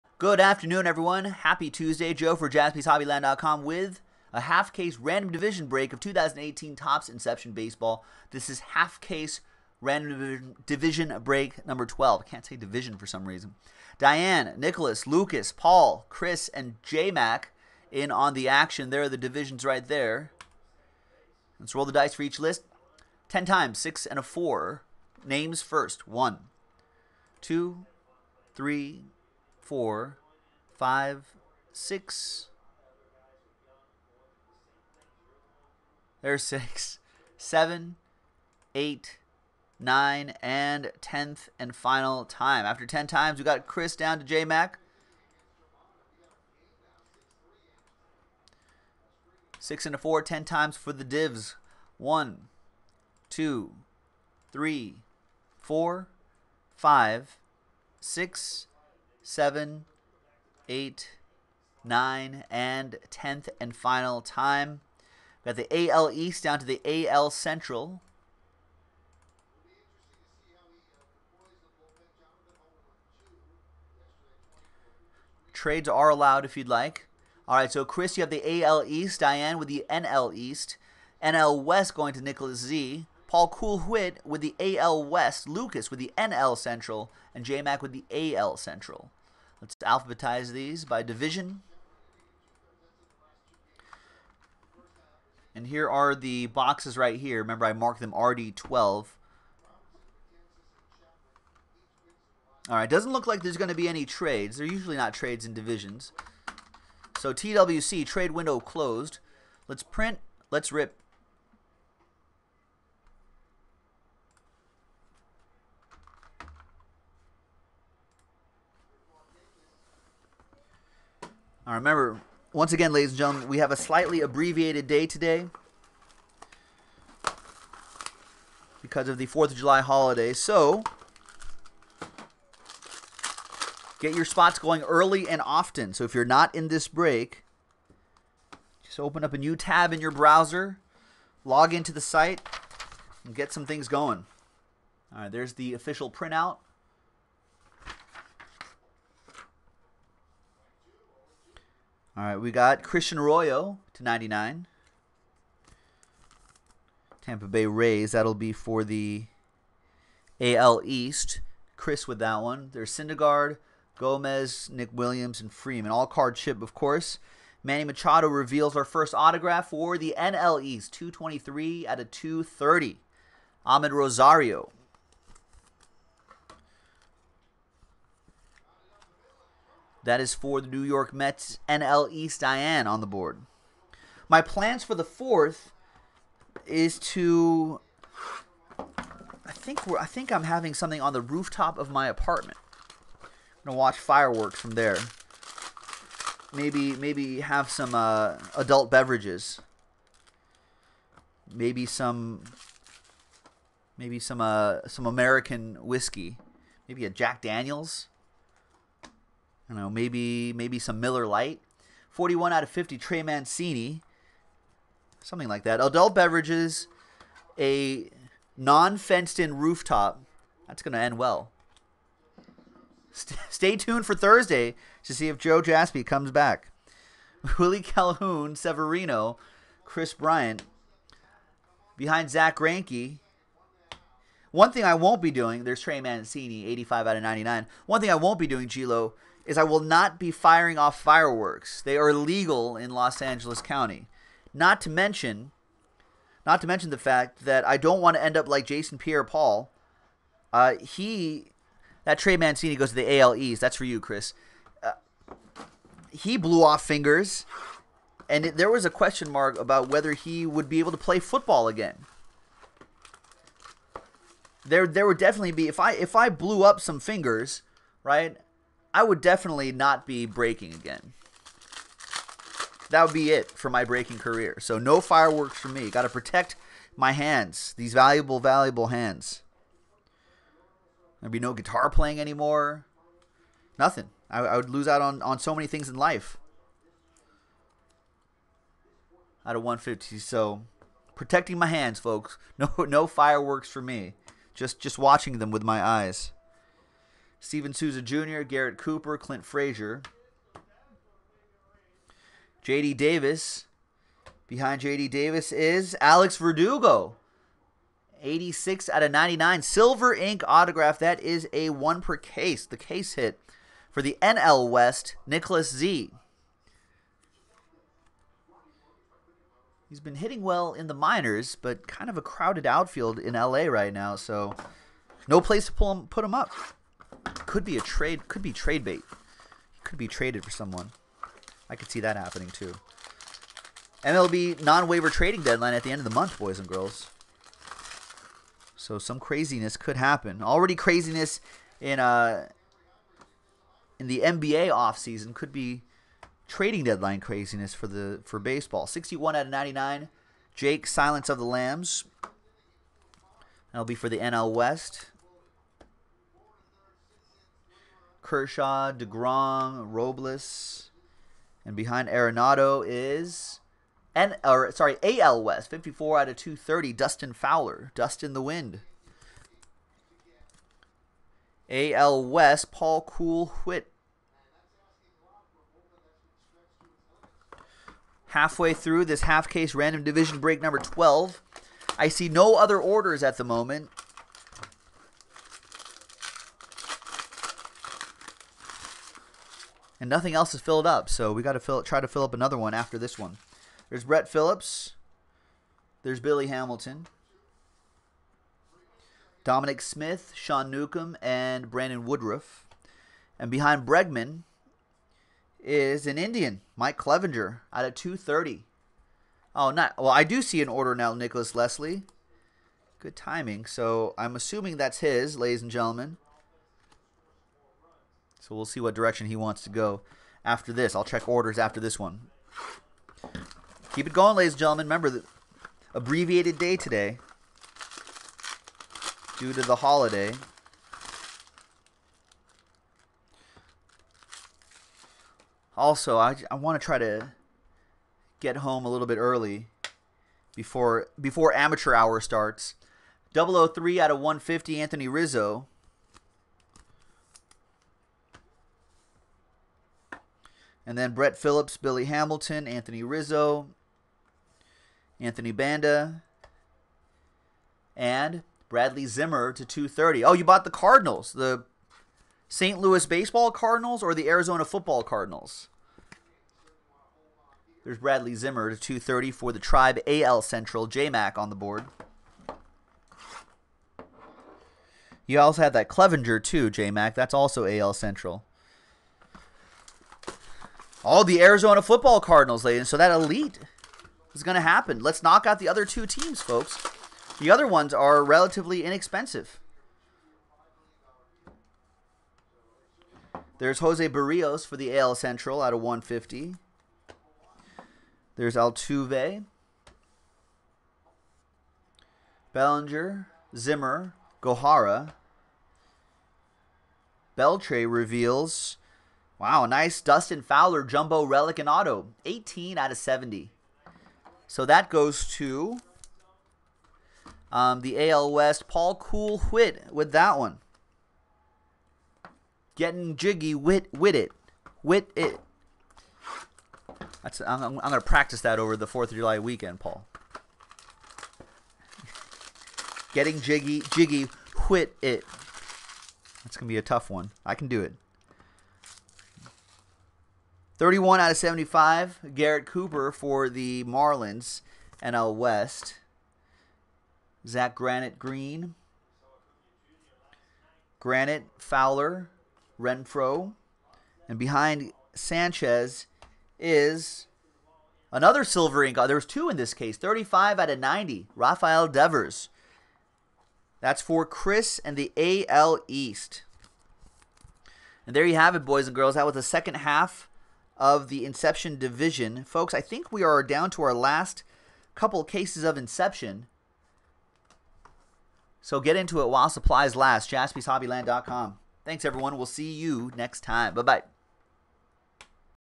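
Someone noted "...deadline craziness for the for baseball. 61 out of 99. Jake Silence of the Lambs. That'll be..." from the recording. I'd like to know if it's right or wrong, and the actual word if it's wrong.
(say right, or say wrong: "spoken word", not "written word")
right.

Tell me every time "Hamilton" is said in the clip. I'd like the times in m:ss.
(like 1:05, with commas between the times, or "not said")
6:36, 7:32.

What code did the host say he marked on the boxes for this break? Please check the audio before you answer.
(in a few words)
RD12.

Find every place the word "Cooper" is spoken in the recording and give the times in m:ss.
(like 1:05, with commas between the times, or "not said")
4:58, 9:02.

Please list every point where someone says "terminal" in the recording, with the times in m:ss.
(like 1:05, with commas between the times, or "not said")
not said.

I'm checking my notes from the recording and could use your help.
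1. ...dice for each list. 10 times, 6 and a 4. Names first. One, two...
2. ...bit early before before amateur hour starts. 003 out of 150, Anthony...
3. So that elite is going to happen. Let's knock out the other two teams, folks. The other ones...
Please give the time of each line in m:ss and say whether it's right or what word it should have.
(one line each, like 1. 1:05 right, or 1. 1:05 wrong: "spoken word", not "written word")
1. 0:21 right
2. 7:19 right
3. 8:02 right.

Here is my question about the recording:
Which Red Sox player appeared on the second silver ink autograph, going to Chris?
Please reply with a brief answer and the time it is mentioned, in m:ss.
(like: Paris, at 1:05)
Rafael Devers, at 9:21.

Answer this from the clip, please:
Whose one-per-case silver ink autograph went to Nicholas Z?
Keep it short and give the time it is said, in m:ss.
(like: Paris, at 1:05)
Alex Verdugo, at 5:06.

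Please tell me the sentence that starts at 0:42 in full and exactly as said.
After ten times, we got Chris down to J Mac.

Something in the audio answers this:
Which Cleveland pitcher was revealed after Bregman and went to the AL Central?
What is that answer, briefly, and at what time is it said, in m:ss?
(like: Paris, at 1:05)
Mike Clevinger, at 6:46.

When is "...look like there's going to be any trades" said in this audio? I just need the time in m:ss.
1:43.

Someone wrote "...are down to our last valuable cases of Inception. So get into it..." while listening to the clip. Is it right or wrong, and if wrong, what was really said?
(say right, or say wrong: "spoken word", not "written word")
wrong: "couple", not "valuable".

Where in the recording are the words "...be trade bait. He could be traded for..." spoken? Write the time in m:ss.
5:28.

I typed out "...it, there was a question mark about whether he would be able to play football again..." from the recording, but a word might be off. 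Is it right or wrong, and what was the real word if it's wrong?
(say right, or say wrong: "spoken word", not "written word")
right.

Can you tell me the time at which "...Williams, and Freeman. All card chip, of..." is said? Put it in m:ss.
2:44.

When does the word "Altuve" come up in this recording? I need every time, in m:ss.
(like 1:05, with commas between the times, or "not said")
8:18.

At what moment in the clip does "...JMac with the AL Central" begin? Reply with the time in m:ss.
1:27.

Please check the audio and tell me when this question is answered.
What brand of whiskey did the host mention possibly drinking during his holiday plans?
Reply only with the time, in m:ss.
3:27.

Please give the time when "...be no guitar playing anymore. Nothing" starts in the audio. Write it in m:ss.
4:41.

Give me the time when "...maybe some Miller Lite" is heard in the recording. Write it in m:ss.
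3:30.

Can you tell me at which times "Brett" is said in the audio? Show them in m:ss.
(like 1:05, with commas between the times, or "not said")
6:34, 7:31.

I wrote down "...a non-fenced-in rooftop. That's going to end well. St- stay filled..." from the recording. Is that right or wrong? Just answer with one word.
wrong.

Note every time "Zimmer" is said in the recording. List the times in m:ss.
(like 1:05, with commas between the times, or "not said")
7:39, 7:48, 8:23.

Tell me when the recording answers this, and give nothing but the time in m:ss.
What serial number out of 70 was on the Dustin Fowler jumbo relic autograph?
8:32.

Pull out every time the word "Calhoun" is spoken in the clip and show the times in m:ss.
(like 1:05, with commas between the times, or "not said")
3:47.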